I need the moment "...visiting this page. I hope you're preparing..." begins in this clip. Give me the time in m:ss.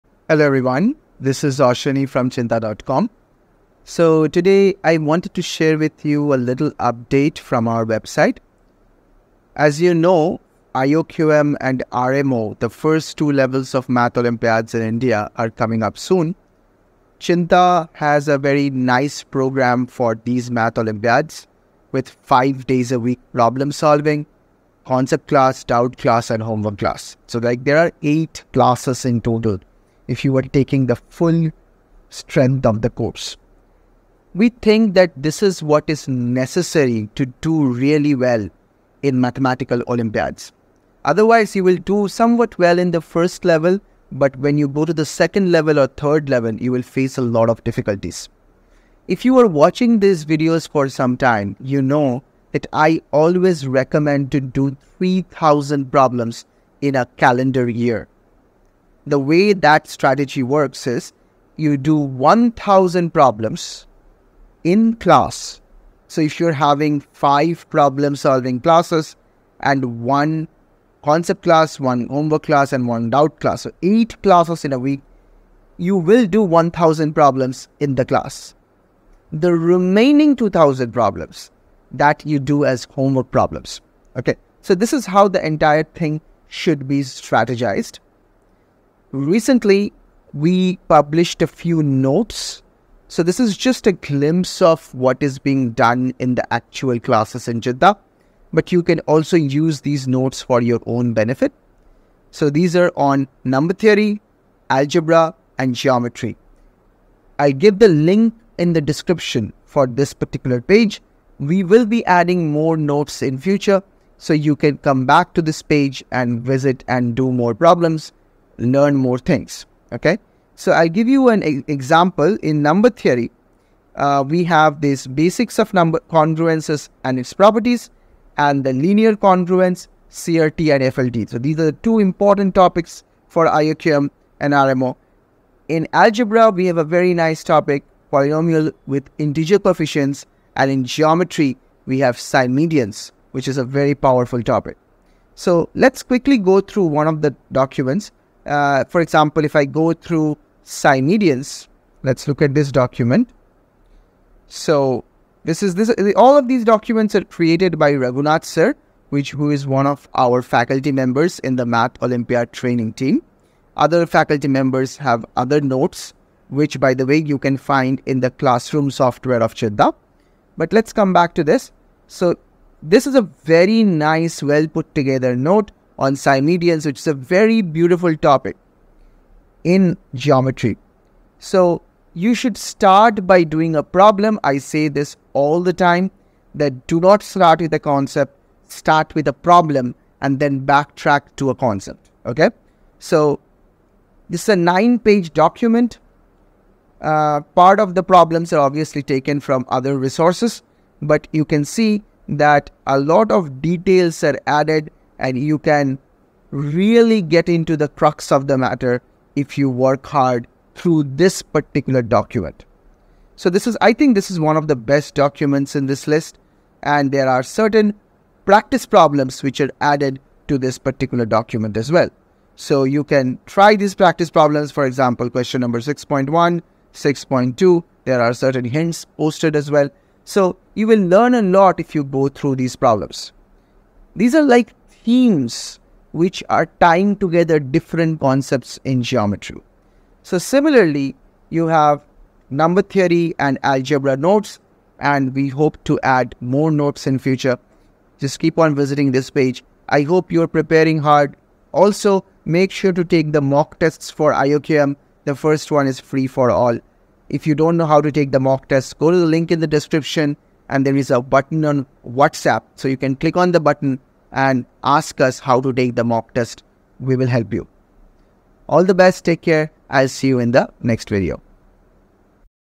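4:08.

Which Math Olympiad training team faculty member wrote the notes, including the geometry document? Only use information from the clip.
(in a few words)
Raghunath.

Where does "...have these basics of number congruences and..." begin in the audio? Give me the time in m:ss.
2:04.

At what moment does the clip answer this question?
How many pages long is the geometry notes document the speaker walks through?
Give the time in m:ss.
3:14.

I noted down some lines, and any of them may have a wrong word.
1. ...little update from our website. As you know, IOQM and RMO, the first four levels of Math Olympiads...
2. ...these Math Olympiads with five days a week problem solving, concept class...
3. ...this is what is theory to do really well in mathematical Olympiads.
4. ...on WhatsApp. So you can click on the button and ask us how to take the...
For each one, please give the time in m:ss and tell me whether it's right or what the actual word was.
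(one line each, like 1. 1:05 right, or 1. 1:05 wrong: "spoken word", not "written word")
1. 0:06 wrong: "two", not "four"
2. 0:20 right
3. 0:35 wrong: "necessary", not "theory"
4. 4:21 right.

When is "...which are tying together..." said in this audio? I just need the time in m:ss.
3:56.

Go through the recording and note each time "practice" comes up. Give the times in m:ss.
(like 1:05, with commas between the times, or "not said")
3:38, 3:43.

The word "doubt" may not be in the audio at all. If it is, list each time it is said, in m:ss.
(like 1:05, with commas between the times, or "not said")
0:25, 1:13.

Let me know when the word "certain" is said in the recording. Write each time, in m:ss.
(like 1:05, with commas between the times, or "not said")
3:37, 3:48.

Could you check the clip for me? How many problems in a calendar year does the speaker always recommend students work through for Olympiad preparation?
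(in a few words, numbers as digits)
3000.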